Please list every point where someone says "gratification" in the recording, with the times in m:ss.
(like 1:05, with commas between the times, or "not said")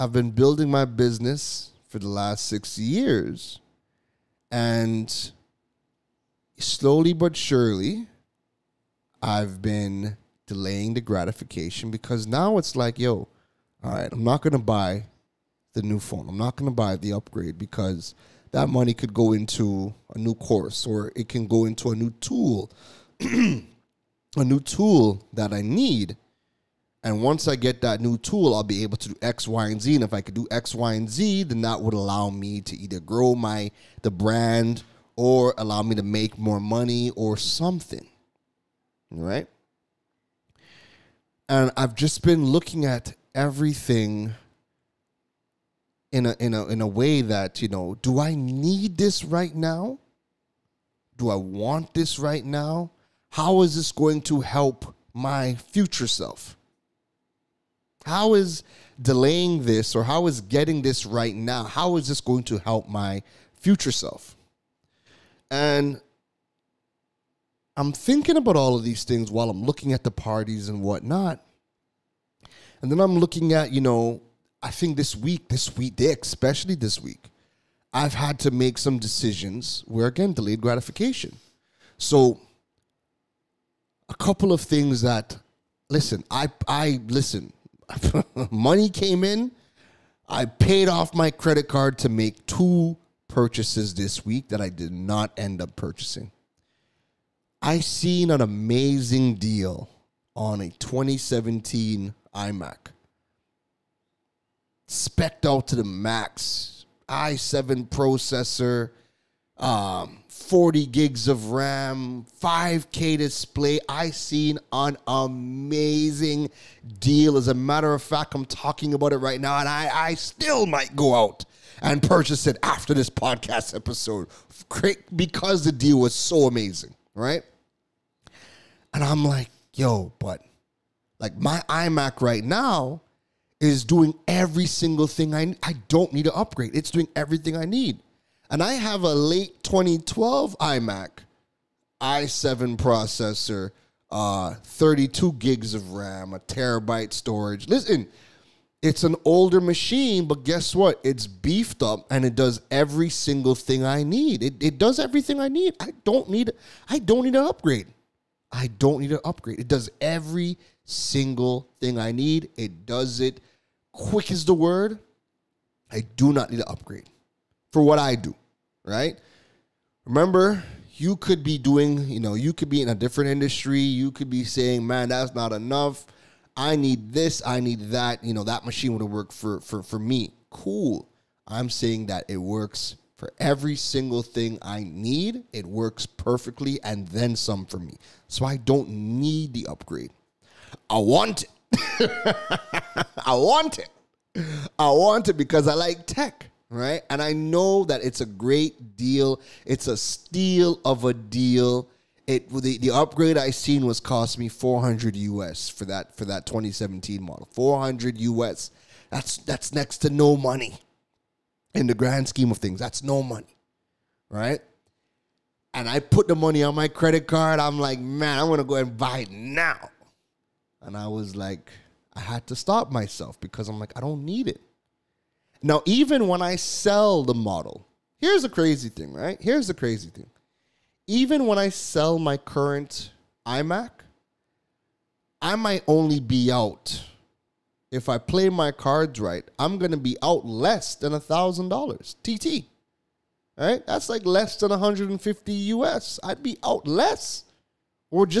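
0:11, 1:20.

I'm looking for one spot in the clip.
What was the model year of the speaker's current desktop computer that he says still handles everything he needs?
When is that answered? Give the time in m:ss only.
2:19.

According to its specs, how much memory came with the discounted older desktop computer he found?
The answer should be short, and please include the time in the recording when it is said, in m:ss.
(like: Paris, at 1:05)
40 GB, at 1:50.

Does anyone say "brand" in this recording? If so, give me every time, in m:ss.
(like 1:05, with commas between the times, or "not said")
0:34.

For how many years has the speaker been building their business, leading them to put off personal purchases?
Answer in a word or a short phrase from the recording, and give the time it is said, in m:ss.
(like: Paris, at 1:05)
6, at 0:02.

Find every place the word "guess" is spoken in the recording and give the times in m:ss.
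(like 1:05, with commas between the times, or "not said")
2:30.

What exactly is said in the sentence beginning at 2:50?
Remember, you could be doing, you know, you could be in a different industry.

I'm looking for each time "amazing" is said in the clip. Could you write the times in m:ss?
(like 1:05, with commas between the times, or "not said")
1:38, 1:55, 2:06.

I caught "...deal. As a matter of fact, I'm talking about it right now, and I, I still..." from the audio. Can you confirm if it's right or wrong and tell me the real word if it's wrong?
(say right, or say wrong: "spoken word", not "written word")
right.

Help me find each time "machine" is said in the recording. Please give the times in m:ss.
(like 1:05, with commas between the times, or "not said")
2:29, 2:58.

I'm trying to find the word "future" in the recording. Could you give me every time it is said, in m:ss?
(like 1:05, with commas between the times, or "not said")
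0:55, 1:03.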